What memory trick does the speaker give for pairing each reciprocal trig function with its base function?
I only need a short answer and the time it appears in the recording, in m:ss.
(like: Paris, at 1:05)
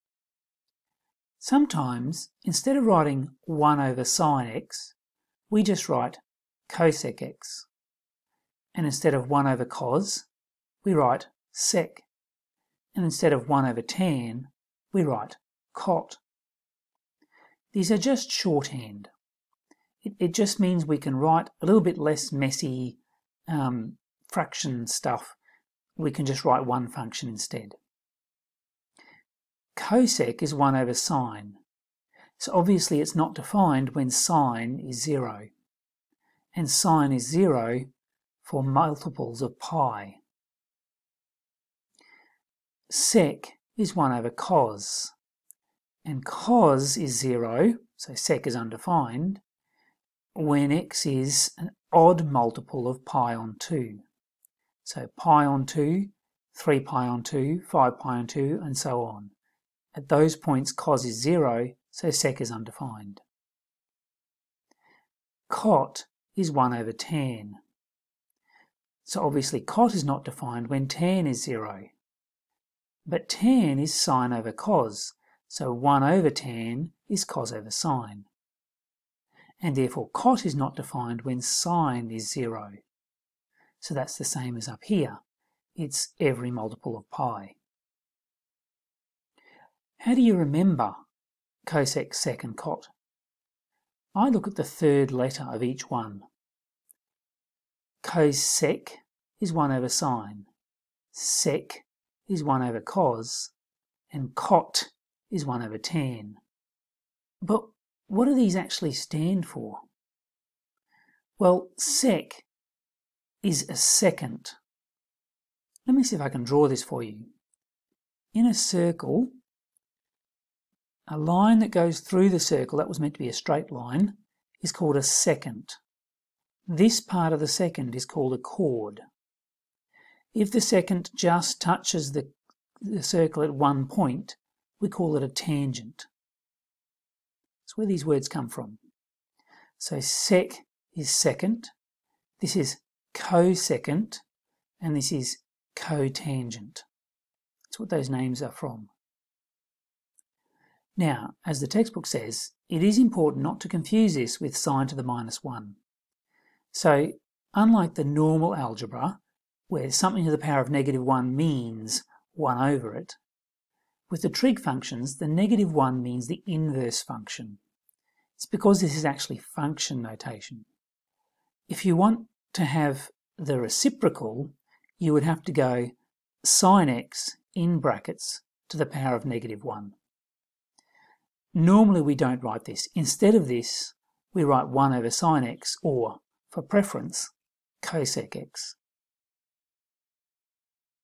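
Look at the third letter, at 1:34.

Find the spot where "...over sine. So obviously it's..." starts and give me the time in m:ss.
0:30.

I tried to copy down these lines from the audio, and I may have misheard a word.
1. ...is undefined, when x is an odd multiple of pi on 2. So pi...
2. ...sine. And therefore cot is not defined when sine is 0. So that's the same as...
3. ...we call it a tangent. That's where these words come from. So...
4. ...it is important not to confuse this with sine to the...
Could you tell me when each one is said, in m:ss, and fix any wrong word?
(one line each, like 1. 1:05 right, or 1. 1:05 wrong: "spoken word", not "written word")
1. 0:48 right
2. 1:17 right
3. 2:14 right
4. 2:32 right.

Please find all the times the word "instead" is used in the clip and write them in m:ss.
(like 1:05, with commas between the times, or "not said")
0:02, 0:08, 0:13, 0:27, 3:02.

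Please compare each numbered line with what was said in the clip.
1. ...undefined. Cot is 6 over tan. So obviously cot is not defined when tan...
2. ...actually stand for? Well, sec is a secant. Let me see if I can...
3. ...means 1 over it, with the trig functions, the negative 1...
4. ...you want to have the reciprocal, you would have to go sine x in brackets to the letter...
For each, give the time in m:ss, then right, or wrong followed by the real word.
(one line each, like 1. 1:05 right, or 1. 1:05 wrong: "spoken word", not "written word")
1. 1:02 wrong: "1", not "6"
2. 1:48 right
3. 2:41 right
4. 2:51 wrong: "power", not "letter".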